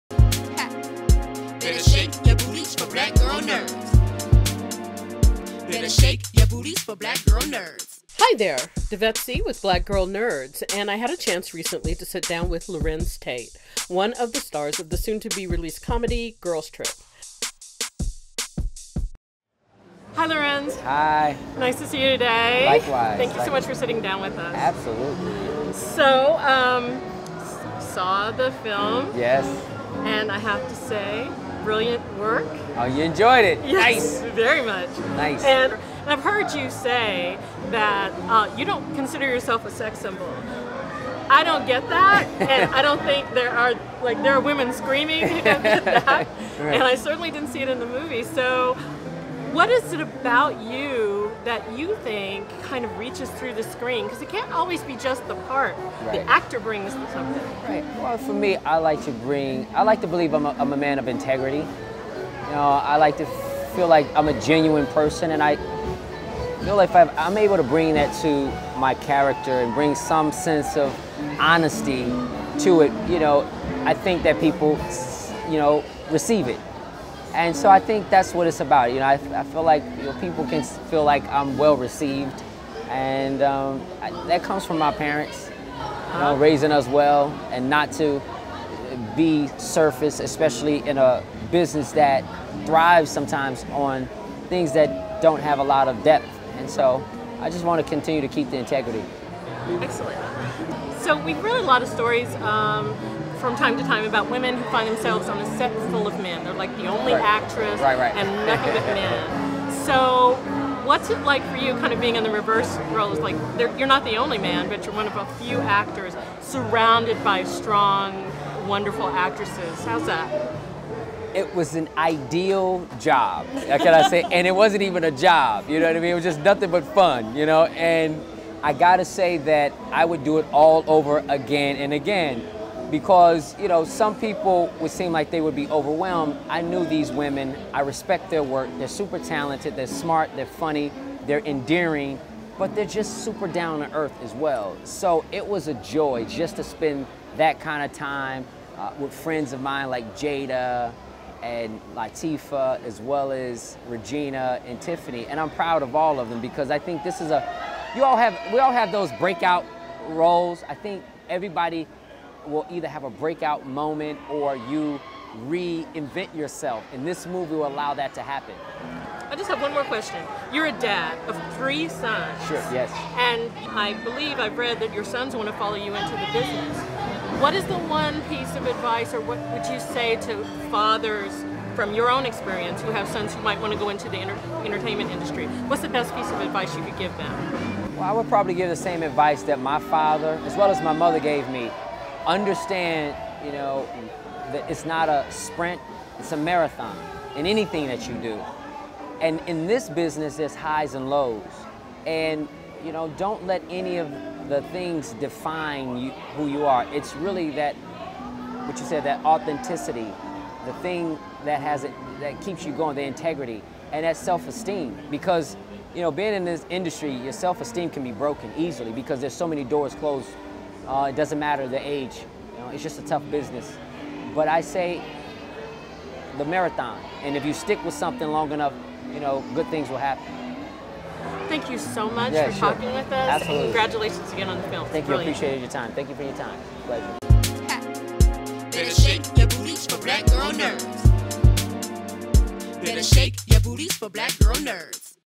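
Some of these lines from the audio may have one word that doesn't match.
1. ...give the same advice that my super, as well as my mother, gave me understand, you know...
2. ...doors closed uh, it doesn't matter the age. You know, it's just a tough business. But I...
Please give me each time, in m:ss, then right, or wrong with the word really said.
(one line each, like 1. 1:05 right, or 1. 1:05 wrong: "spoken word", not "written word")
1. 3:08 wrong: "father", not "super"
2. 3:39 right.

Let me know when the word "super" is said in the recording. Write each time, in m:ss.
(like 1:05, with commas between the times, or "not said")
2:18, 2:23.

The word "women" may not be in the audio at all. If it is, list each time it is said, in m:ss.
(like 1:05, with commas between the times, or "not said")
0:44, 1:44, 2:17.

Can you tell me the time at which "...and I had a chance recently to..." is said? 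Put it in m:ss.
0:10.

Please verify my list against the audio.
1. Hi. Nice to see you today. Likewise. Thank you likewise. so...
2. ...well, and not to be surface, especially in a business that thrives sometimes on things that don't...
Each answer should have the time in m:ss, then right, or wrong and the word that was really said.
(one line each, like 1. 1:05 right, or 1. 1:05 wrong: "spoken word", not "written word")
1. 0:20 right
2. 1:26 right.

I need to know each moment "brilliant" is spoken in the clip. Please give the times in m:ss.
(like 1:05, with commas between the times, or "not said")
0:31, 3:55.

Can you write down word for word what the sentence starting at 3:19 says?
And in this business, there's highs and lows.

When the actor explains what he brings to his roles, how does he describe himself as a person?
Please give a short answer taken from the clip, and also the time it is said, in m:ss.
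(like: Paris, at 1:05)
a man of integrity, at 1:00.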